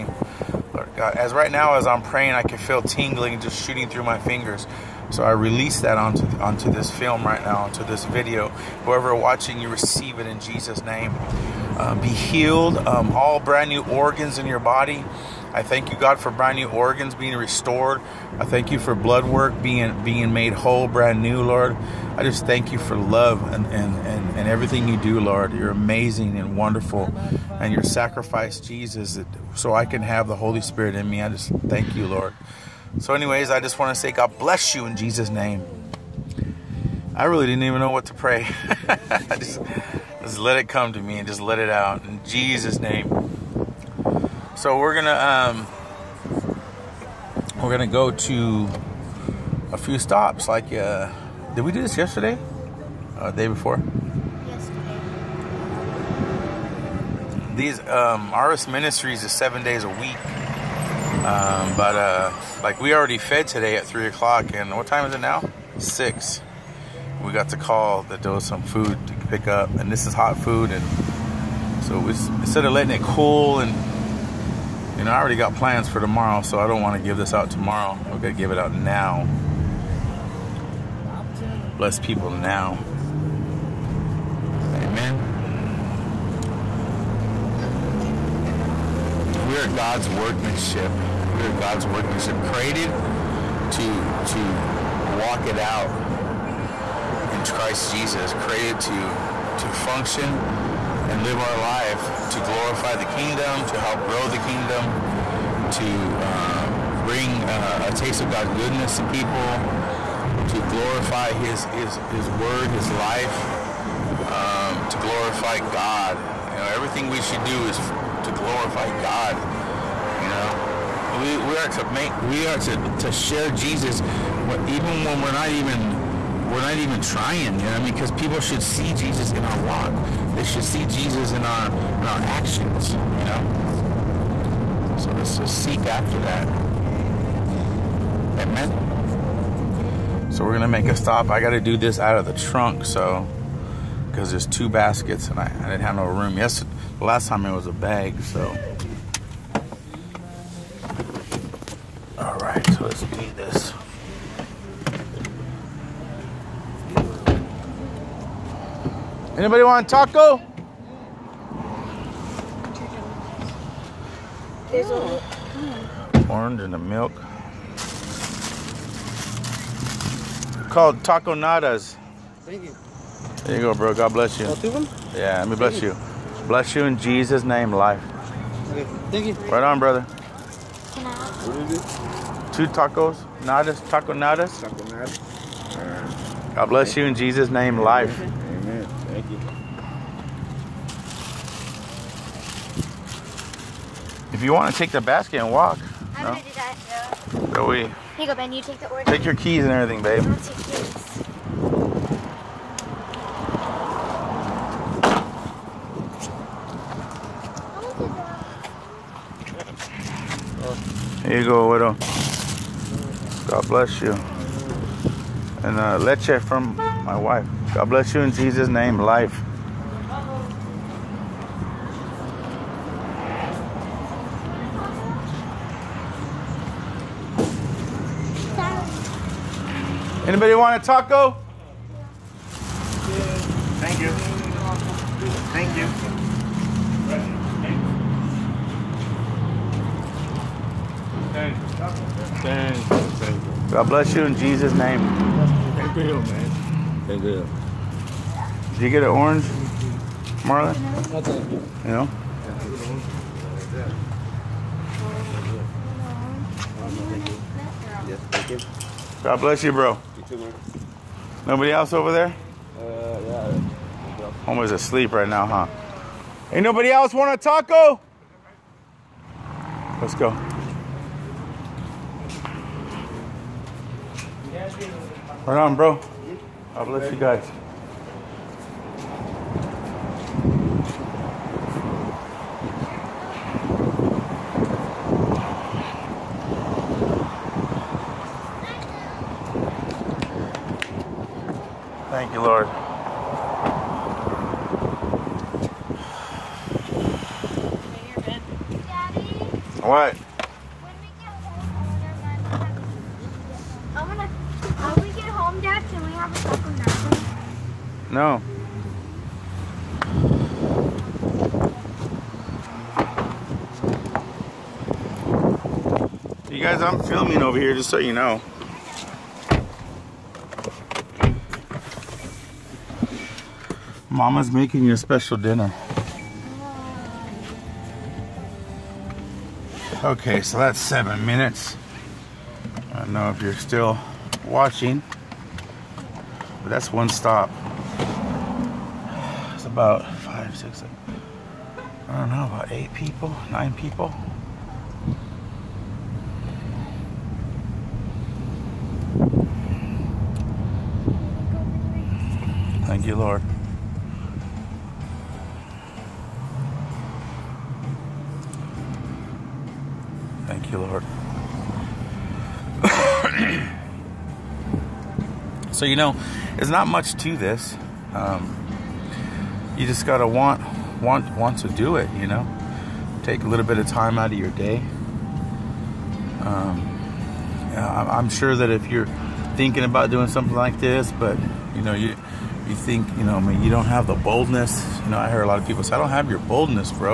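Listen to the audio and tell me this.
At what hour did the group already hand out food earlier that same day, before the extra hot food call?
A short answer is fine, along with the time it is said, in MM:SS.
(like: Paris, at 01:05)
3 o'clock, at 01:03.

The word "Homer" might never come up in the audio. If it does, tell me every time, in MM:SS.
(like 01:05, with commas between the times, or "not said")
04:24.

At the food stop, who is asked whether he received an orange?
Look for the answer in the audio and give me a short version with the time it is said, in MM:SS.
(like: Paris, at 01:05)
Marlon, at 04:10.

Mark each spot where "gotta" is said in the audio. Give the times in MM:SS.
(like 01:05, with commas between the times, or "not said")
02:21, 06:10.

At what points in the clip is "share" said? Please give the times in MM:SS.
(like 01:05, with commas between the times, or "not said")
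02:03.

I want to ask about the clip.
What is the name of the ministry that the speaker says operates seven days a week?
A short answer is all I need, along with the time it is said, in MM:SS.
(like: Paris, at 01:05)
Artist Ministries, at 00:58.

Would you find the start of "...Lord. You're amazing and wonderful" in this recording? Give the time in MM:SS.
00:25.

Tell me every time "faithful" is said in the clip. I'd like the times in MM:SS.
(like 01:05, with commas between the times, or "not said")
not said.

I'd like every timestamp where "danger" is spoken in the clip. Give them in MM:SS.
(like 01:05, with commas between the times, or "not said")
not said.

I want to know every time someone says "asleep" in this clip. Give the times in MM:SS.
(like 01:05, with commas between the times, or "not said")
04:24.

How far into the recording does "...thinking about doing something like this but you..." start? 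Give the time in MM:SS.
06:19.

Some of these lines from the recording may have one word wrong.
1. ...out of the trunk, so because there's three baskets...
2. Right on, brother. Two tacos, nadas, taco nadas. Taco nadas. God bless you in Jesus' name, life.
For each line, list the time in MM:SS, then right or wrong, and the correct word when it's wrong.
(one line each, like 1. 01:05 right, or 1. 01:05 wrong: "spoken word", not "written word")
1. 02:21 wrong: "two", not "three"
2. 02:59 right.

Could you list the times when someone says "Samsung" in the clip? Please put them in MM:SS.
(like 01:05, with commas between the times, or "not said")
not said.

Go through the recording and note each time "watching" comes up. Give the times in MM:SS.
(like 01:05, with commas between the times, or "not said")
00:09, 05:34.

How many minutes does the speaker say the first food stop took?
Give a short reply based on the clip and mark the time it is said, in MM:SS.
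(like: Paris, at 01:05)
7, at 05:30.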